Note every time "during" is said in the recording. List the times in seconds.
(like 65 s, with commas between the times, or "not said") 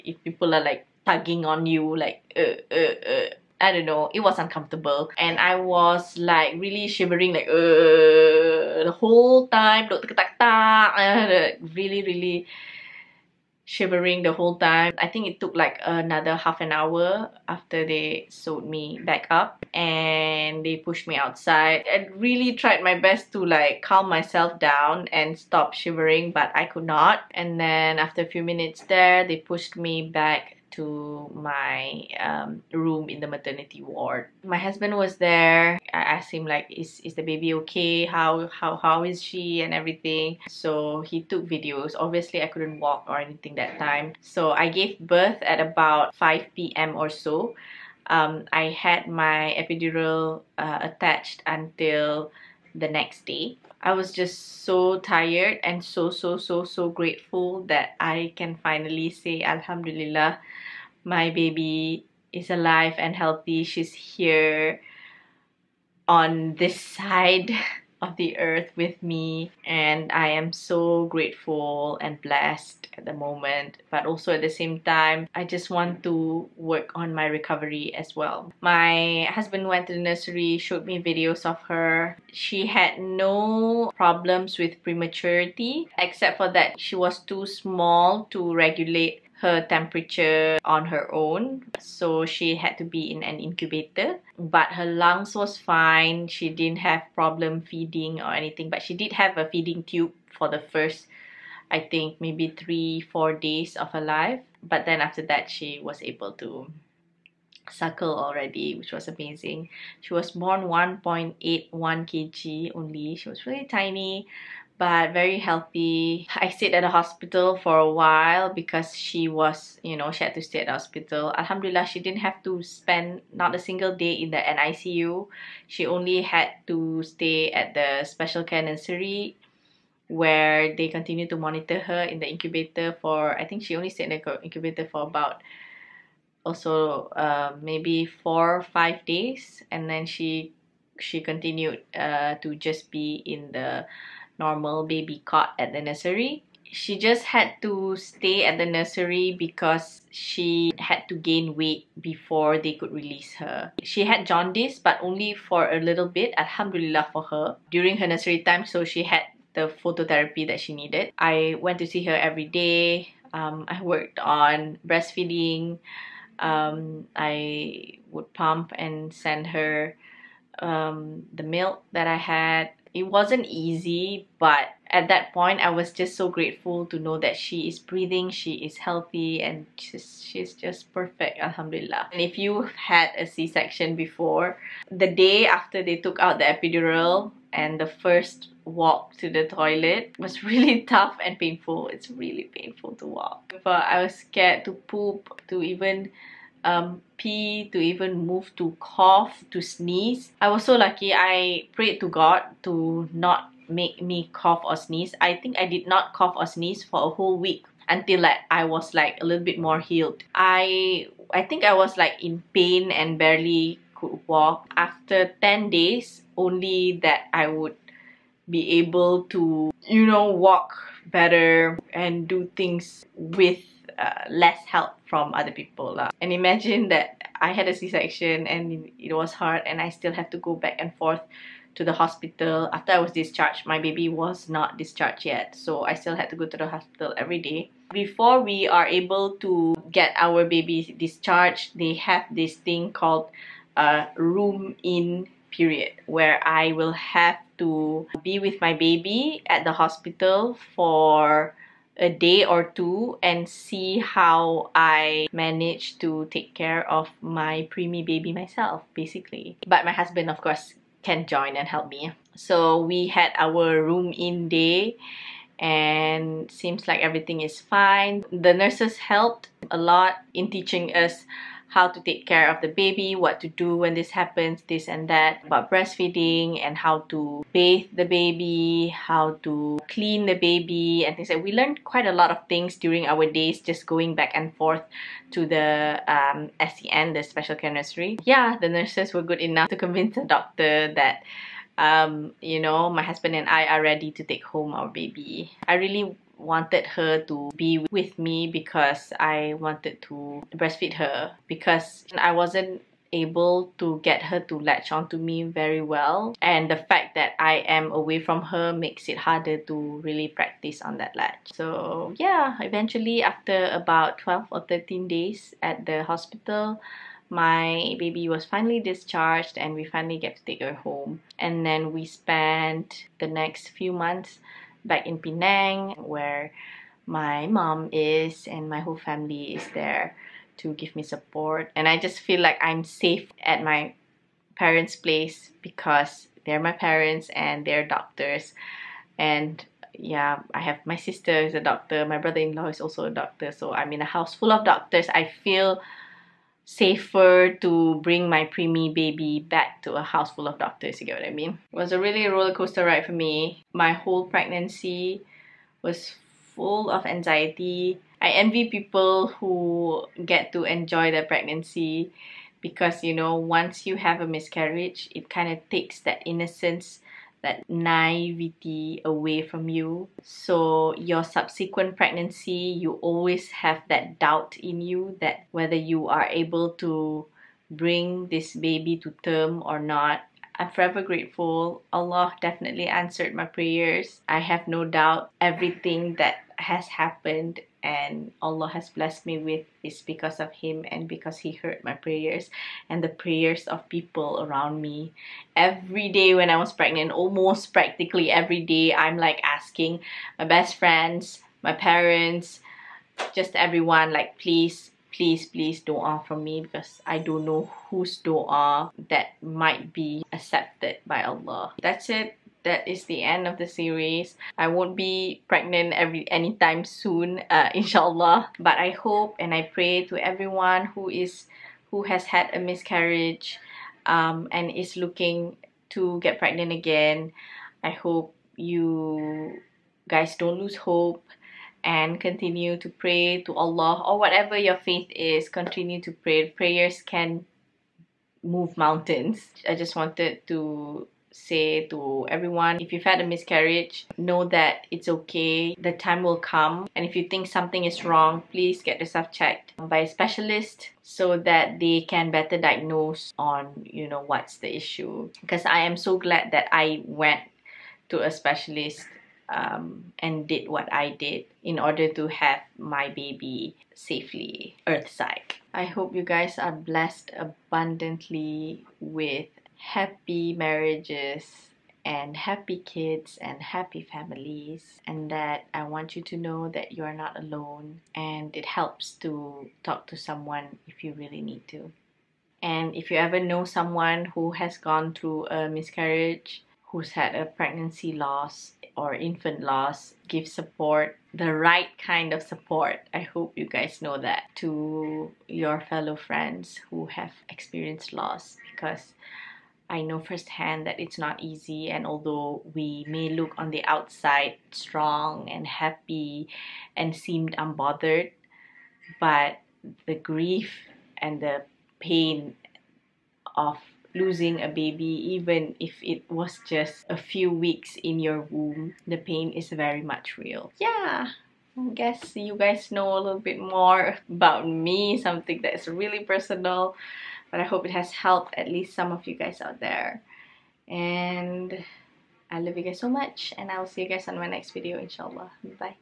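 157 s, 282 s.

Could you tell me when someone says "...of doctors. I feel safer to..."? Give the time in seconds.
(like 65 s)
344 s.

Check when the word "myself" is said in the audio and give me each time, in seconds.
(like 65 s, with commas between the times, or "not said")
24 s, 258 s.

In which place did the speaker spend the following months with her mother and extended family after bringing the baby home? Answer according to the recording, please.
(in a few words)
Penang.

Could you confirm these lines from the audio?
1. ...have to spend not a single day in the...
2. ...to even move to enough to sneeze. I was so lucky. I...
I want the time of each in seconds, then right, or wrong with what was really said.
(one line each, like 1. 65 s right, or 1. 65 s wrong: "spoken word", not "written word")
1. 122 s right
2. 197 s wrong: "cough", not "enough".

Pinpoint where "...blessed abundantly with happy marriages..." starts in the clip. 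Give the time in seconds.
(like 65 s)
466 s.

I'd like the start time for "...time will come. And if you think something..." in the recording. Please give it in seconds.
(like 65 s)
445 s.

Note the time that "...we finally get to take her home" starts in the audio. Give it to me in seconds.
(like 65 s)
319 s.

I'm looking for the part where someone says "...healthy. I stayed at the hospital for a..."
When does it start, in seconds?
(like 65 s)
115 s.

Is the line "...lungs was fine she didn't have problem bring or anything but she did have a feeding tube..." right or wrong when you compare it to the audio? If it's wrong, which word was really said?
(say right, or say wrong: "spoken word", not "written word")
wrong: "feeding", not "bring".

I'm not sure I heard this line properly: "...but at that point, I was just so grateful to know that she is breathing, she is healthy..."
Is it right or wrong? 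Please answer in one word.
right.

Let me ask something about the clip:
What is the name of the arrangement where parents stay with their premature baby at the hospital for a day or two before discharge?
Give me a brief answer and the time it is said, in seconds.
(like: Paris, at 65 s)
Room in period, at 244 s.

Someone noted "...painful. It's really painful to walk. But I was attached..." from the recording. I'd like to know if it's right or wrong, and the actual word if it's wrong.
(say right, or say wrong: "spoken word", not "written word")
wrong: "scared", not "attached".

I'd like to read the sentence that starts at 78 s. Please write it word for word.
My husband went to the nursery, showed me videos of her.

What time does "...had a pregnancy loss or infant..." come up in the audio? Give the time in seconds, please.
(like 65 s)
487 s.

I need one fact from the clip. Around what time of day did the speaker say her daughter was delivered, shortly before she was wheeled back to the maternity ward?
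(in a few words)
5 p.m.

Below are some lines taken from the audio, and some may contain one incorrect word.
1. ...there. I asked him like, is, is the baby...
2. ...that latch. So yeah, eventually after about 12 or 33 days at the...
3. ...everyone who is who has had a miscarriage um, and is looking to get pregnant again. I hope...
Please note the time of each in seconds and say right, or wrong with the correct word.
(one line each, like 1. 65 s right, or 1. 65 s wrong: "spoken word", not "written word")
1. 35 s right
2. 310 s wrong: "13", not "33"
3. 420 s right.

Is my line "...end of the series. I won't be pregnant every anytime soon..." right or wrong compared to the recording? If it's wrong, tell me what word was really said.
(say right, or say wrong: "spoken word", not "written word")
right.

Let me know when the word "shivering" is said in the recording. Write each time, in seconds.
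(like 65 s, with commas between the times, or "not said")
6 s, 13 s, 25 s.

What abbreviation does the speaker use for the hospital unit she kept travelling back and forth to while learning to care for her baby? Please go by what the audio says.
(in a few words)
SCN.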